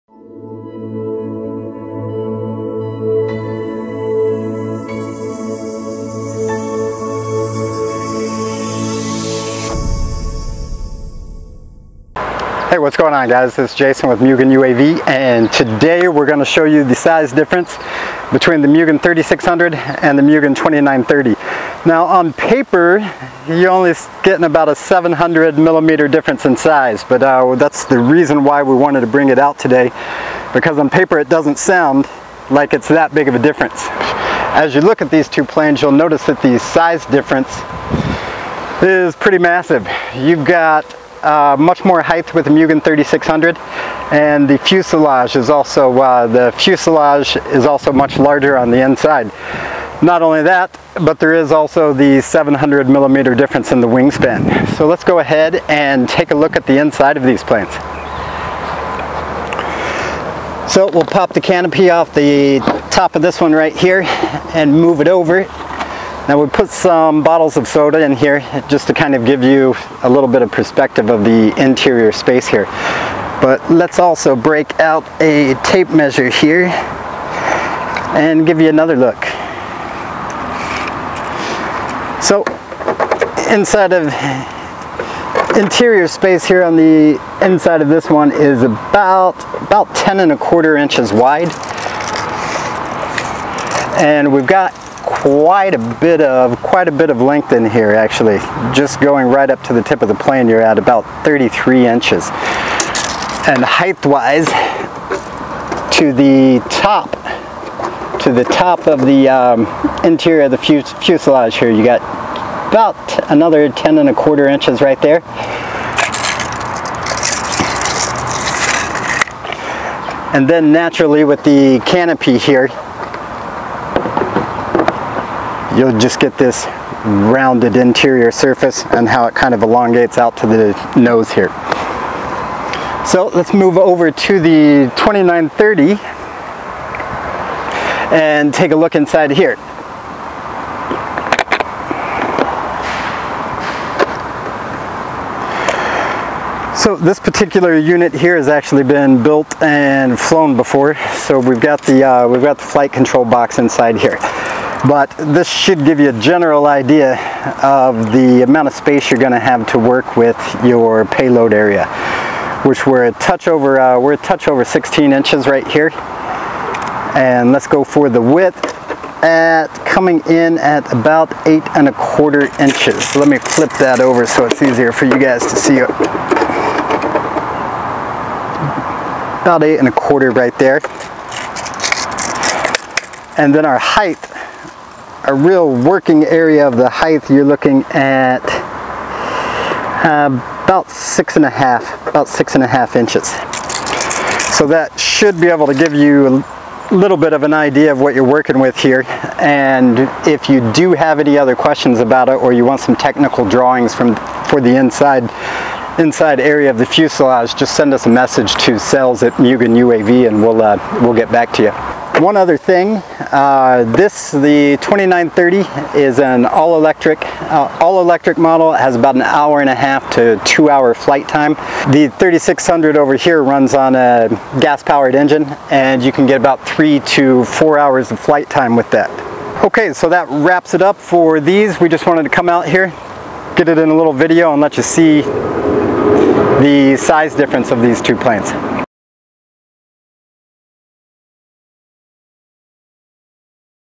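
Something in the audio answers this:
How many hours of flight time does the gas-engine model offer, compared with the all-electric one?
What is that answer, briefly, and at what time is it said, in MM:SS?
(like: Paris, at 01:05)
3 to 4 hours, at 03:46.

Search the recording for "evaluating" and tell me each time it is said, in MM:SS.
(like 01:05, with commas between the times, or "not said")
not said.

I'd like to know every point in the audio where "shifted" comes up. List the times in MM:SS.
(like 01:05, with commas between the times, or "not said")
not said.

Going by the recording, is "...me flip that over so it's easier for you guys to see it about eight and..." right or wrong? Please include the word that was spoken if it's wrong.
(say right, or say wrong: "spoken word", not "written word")
right.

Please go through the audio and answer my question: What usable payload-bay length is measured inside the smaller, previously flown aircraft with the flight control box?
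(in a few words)
16 inches.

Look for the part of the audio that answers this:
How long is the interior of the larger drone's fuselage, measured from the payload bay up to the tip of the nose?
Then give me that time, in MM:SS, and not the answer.
01:41.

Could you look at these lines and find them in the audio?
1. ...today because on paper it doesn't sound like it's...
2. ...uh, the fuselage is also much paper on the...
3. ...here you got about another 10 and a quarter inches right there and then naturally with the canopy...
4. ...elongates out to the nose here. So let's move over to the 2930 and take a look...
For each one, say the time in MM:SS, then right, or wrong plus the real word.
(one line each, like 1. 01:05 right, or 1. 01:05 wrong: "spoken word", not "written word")
1. 00:29 right
2. 00:45 wrong: "larger", not "paper"
3. 01:51 right
4. 02:09 right.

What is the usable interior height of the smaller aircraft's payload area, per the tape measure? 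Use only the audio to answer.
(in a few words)
6.5 inches.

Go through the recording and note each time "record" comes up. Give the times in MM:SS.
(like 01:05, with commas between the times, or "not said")
not said.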